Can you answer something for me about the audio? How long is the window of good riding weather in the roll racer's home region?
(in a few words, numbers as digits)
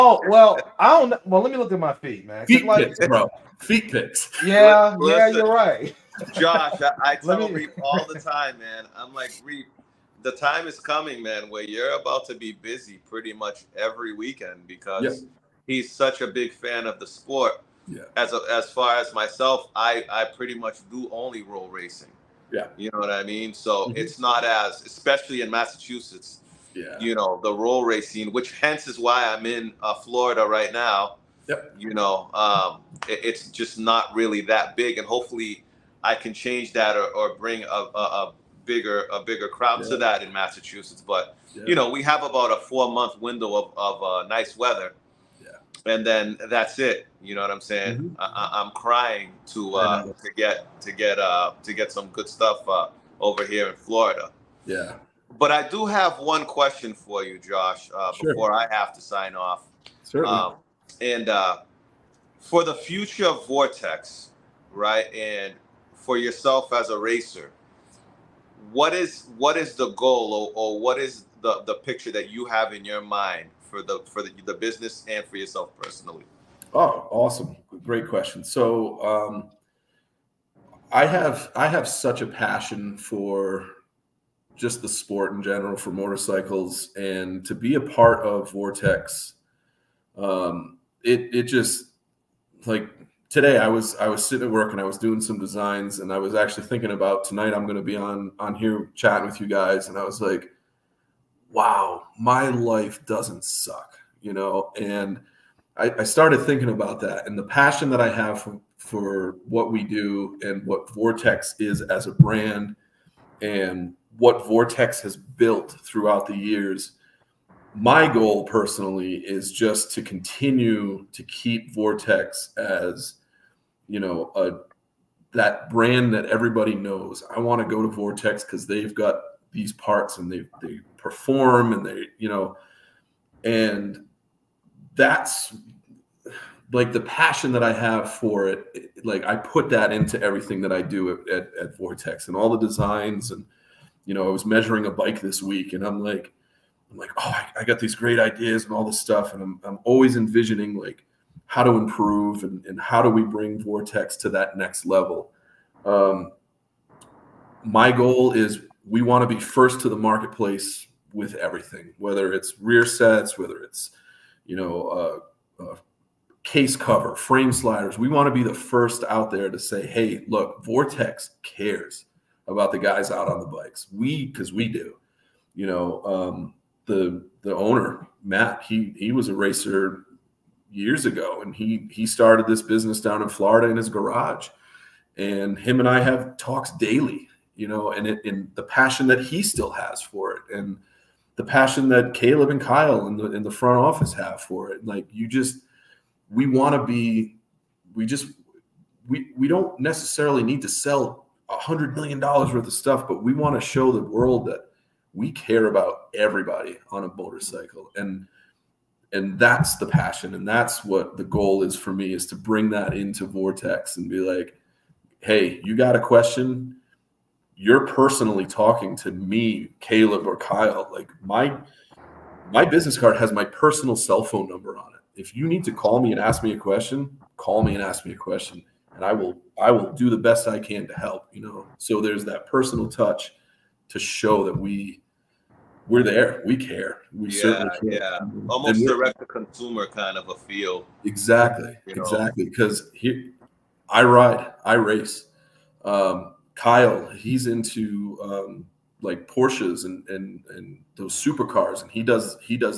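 4 months.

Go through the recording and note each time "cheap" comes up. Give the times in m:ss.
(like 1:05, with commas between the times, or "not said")
not said.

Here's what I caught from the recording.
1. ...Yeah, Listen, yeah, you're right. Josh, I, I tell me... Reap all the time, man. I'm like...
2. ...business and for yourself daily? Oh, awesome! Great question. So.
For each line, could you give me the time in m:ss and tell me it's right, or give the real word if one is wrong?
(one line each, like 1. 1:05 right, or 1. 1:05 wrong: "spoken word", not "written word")
1. 0:04 right
2. 1:14 wrong: "personally", not "daily".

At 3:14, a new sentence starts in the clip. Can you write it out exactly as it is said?
Like you just, we want to be, we just.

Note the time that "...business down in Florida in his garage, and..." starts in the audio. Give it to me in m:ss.
3:02.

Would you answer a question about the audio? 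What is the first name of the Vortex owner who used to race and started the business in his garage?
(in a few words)
Matt.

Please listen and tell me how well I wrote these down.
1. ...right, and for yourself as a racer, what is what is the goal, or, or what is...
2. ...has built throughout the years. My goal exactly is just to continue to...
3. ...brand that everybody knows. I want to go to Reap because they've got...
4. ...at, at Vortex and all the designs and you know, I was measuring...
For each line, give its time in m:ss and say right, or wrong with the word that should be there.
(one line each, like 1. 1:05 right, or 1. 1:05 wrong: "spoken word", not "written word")
1. 1:04 right
2. 1:55 wrong: "personally", not "exactly"
3. 2:05 wrong: "Vortex", not "Reap"
4. 2:21 right.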